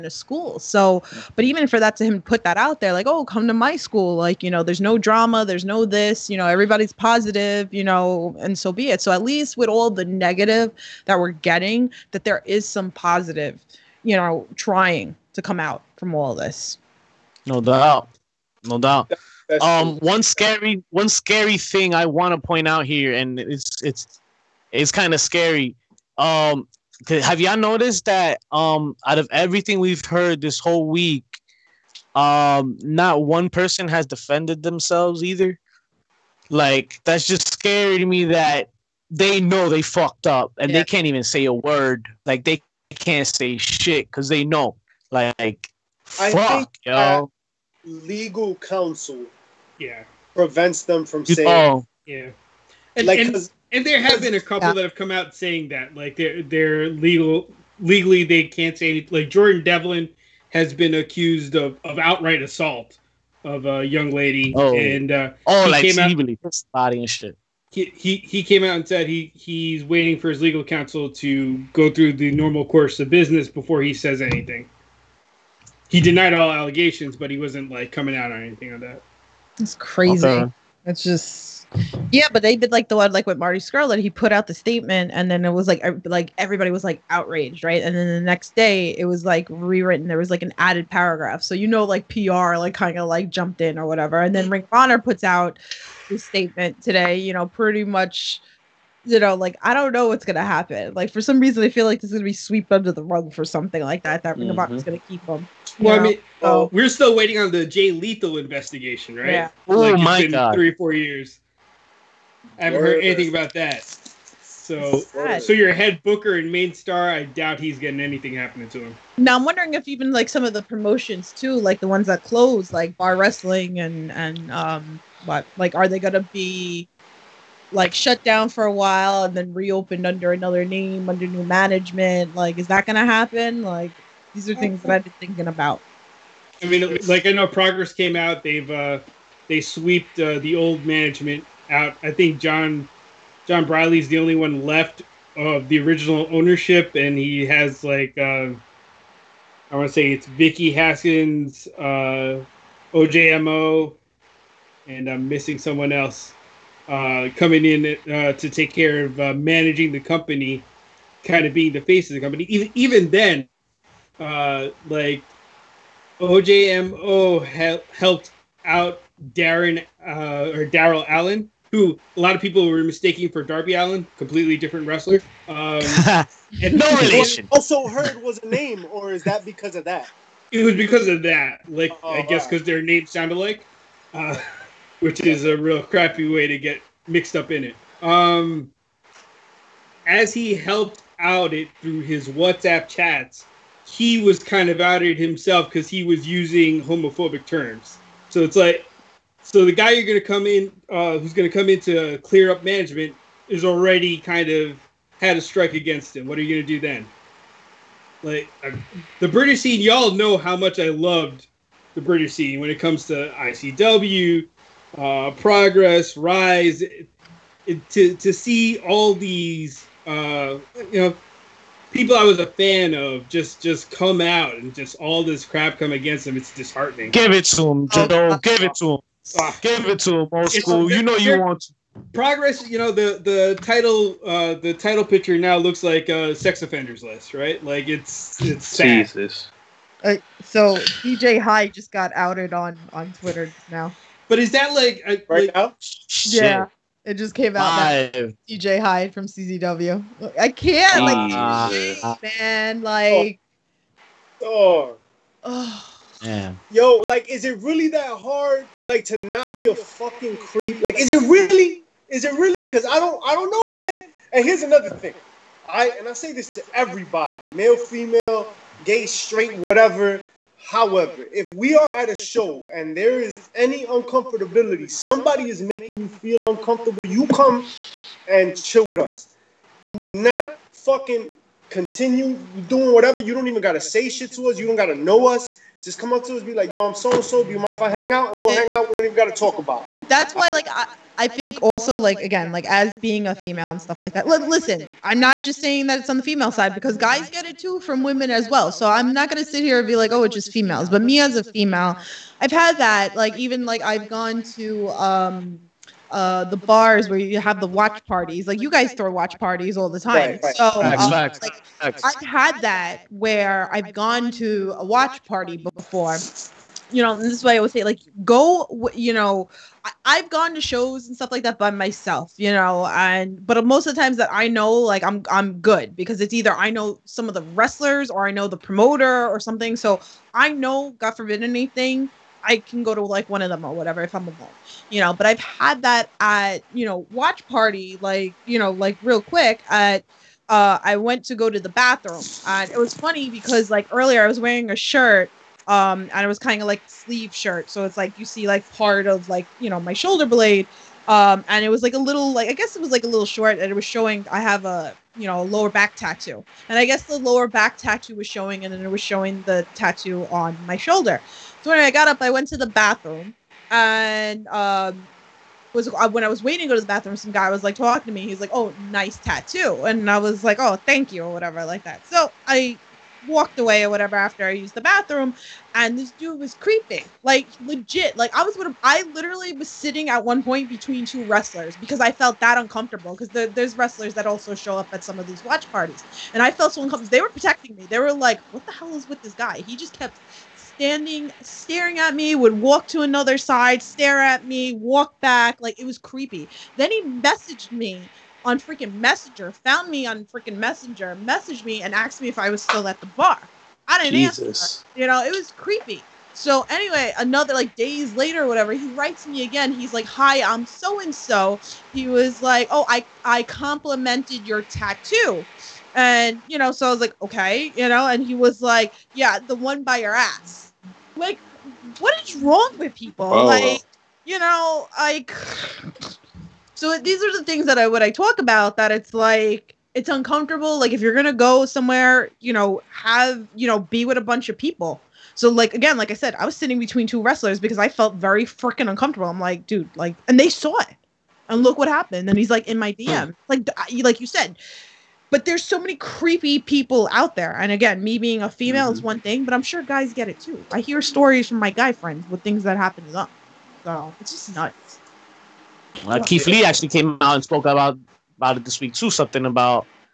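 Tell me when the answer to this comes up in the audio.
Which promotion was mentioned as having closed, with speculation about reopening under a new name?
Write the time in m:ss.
2:02.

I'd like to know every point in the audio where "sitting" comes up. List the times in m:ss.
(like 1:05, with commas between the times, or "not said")
6:19, 7:16.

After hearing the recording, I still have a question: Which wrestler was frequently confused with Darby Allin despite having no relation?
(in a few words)
Daryl Allen.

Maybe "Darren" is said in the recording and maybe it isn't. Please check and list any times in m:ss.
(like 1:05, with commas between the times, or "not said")
2:49.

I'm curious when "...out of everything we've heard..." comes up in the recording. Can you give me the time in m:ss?
0:29.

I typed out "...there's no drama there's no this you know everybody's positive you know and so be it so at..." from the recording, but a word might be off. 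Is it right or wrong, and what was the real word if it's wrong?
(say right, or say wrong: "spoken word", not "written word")
right.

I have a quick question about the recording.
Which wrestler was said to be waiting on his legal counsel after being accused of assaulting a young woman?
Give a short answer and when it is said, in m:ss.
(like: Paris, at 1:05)
Jordan Devlin, at 0:59.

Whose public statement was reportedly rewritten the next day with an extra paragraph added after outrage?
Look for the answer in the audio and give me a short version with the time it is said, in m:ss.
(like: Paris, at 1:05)
Marty Scurll, at 1:23.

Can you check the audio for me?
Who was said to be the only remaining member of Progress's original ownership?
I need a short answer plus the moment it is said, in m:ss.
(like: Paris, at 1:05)
Jon Briley, at 2:23.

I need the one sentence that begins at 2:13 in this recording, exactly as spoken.
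Like, these are things that I've been thinking about.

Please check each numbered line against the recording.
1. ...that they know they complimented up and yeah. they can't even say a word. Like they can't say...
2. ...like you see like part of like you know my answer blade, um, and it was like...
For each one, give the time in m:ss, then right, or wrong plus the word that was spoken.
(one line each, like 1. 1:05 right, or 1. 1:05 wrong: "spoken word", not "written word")
1. 0:38 wrong: "fucked", not "complimented"
2. 5:47 wrong: "shoulder", not "answer".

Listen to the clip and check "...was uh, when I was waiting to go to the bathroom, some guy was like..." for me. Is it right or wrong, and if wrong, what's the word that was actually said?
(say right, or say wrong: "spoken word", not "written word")
right.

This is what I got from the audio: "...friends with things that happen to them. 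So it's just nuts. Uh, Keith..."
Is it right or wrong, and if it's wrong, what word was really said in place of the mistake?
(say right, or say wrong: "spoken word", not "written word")
right.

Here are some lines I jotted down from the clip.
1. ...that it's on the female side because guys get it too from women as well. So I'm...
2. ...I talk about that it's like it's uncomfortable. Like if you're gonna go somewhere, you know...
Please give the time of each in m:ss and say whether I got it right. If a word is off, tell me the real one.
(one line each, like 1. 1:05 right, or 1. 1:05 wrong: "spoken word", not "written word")
1. 4:55 right
2. 7:08 right.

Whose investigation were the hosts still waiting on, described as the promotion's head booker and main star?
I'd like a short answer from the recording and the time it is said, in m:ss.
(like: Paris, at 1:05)
Jay Lethal, at 1:47.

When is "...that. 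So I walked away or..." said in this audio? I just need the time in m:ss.
6:11.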